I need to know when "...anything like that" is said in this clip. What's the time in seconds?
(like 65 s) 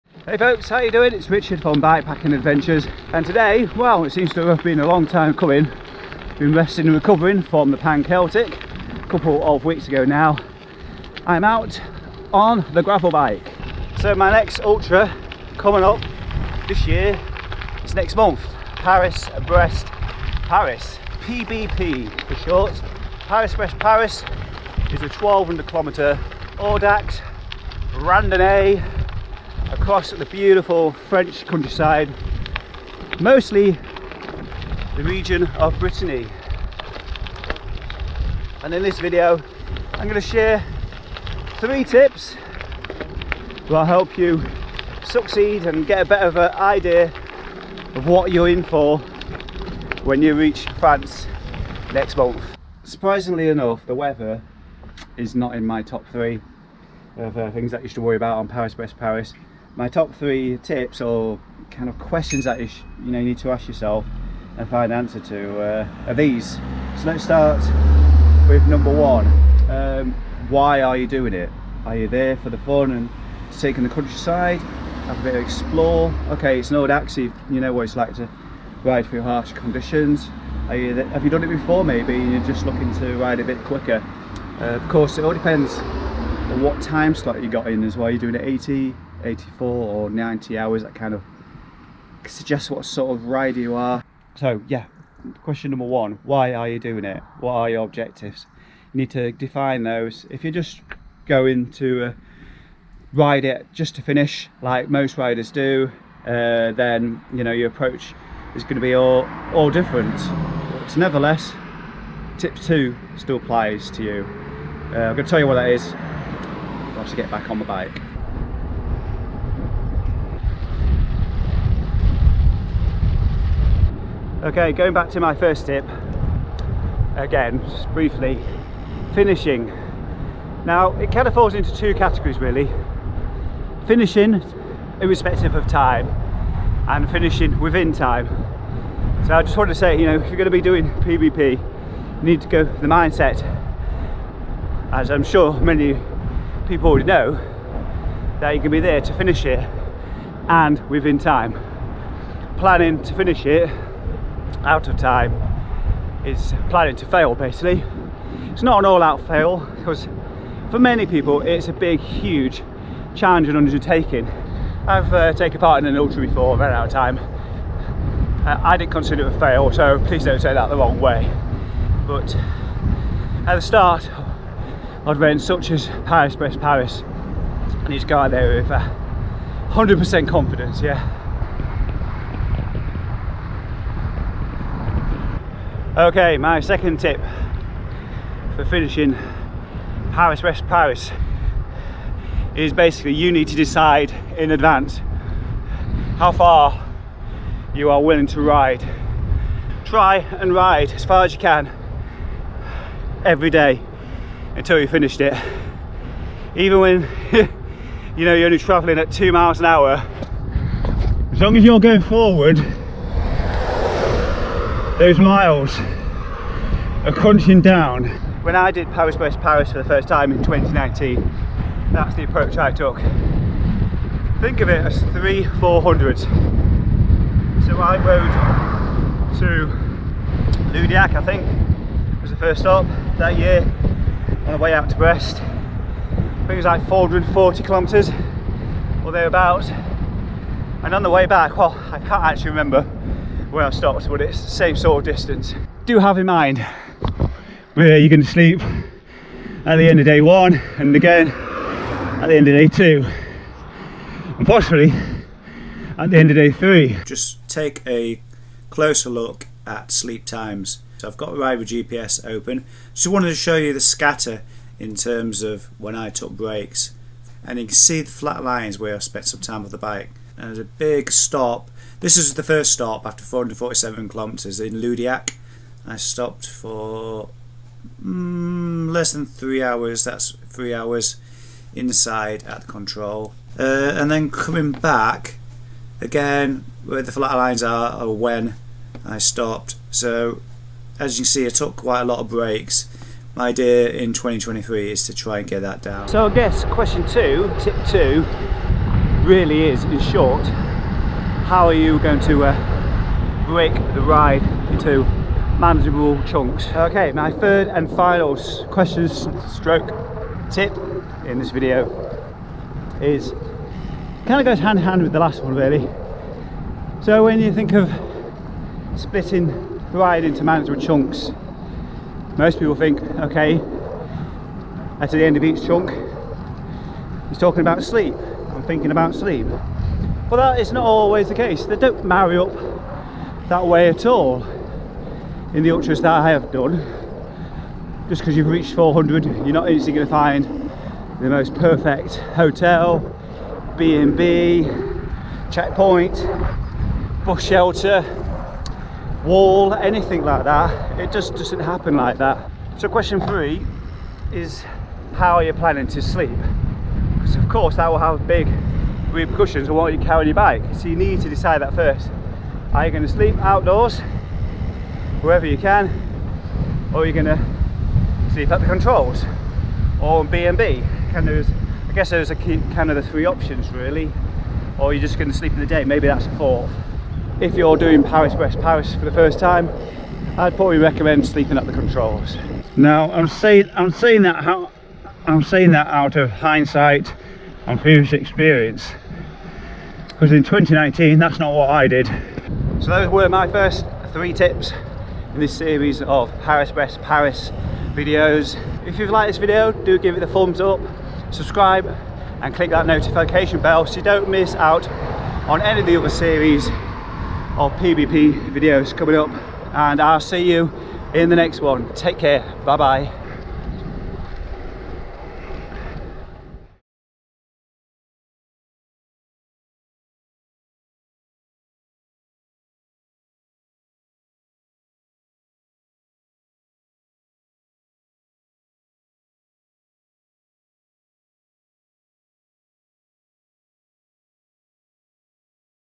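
349 s.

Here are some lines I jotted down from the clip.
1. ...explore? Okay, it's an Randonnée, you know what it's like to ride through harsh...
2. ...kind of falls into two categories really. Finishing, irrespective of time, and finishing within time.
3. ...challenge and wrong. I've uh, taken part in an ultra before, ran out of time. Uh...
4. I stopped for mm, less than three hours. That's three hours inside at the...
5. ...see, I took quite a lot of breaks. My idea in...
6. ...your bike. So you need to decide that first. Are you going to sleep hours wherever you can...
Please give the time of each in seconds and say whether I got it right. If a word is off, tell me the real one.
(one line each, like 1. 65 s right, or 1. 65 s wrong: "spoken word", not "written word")
1. 75 s wrong: "Audax", not "Randonnée"
2. 131 s right
3. 163 s wrong: "undertaking", not "wrong"
4. 275 s right
5. 291 s right
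6. 360 s wrong: "outdoors", not "hours".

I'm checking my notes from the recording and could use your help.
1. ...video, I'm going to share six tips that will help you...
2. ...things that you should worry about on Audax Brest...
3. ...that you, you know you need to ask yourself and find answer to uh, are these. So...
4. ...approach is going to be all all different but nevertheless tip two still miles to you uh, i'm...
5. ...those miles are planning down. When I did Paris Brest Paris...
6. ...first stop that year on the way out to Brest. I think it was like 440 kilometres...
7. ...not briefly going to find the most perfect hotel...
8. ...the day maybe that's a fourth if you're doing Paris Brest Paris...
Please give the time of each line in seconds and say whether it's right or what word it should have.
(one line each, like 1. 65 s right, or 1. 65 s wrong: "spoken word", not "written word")
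1. 38 s wrong: "three", not "six"
2. 57 s wrong: "Paris", not "Audax"
3. 62 s right
4. 107 s wrong: "applies", not "miles"
5. 214 s wrong: "crunching", not "planning"
6. 232 s right
7. 339 s wrong: "instantly", not "briefly"
8. 375 s right.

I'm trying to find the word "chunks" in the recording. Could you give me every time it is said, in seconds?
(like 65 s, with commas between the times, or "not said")
306 s, 320 s, 325 s.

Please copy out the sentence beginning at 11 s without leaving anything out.
I'm out on the gravel bike.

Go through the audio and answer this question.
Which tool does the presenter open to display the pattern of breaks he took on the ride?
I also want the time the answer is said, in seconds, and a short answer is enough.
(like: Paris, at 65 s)
Riva GPS, at 261 s.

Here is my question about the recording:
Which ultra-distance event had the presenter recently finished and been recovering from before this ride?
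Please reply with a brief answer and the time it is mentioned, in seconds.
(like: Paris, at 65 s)
Pan Celtic, at 7 s.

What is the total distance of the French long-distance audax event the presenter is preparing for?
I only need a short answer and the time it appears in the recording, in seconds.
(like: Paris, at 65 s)
1200 kilometres, at 25 s.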